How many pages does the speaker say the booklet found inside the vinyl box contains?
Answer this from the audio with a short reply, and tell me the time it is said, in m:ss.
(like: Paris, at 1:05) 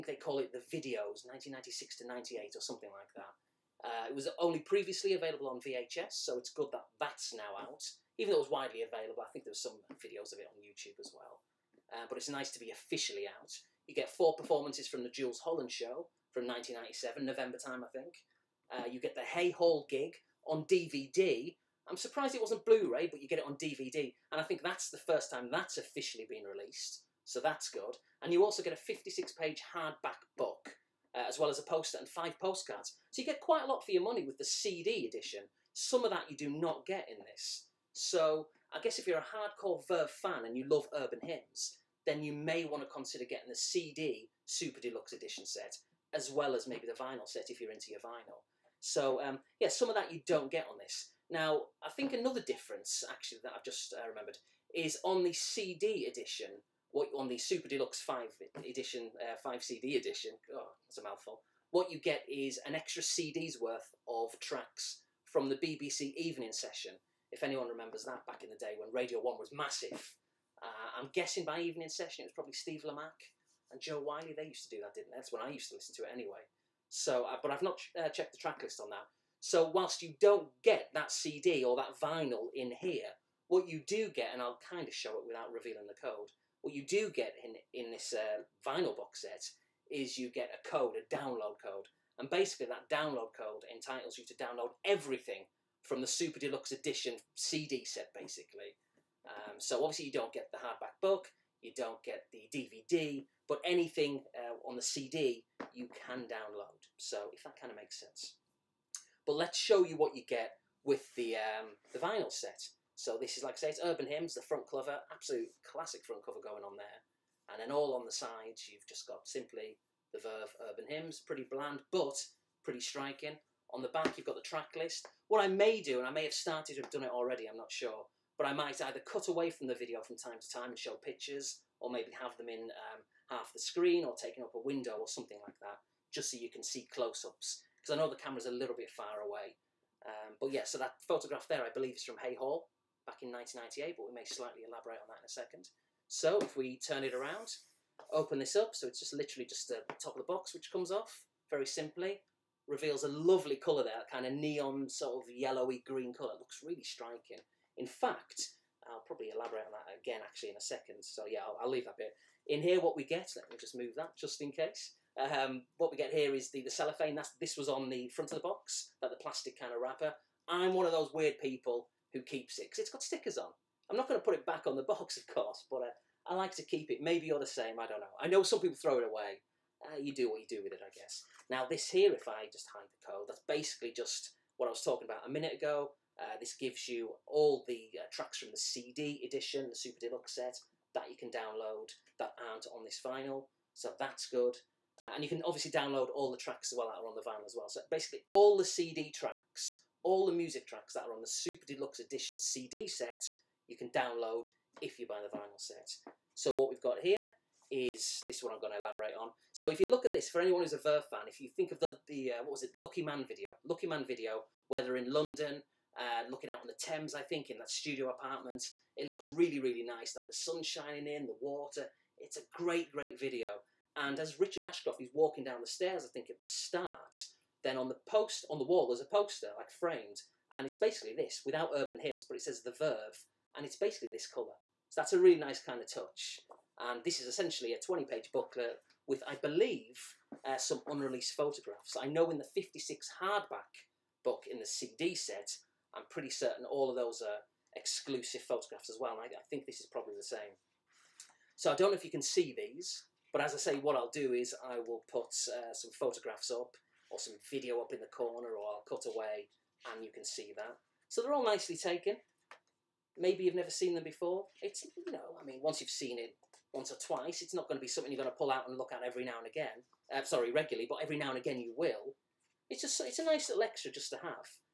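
20, at 3:57.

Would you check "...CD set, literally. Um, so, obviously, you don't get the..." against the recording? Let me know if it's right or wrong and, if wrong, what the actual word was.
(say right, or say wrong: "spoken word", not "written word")
wrong: "basically", not "literally".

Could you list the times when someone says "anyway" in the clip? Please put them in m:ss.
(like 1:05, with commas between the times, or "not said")
1:16.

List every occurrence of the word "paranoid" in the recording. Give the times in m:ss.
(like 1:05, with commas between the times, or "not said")
not said.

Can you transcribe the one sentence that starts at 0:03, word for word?
Uh, it was only previously available on VHS, so it's good that that's now out.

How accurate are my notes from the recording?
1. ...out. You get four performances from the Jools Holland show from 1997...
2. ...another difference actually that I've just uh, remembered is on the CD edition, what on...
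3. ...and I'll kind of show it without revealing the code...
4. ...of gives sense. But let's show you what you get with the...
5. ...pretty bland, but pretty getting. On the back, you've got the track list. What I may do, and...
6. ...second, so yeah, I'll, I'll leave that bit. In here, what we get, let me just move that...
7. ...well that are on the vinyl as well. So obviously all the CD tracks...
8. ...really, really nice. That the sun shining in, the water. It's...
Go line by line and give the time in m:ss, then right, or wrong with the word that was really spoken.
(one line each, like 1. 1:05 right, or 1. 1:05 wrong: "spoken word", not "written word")
1. 0:13 right
2. 0:52 right
3. 1:24 right
4. 1:47 wrong: "makes", not "gives"
5. 2:01 wrong: "striking", not "getting"
6. 2:40 right
7. 3:16 wrong: "basically", not "obviously"
8. 3:39 right.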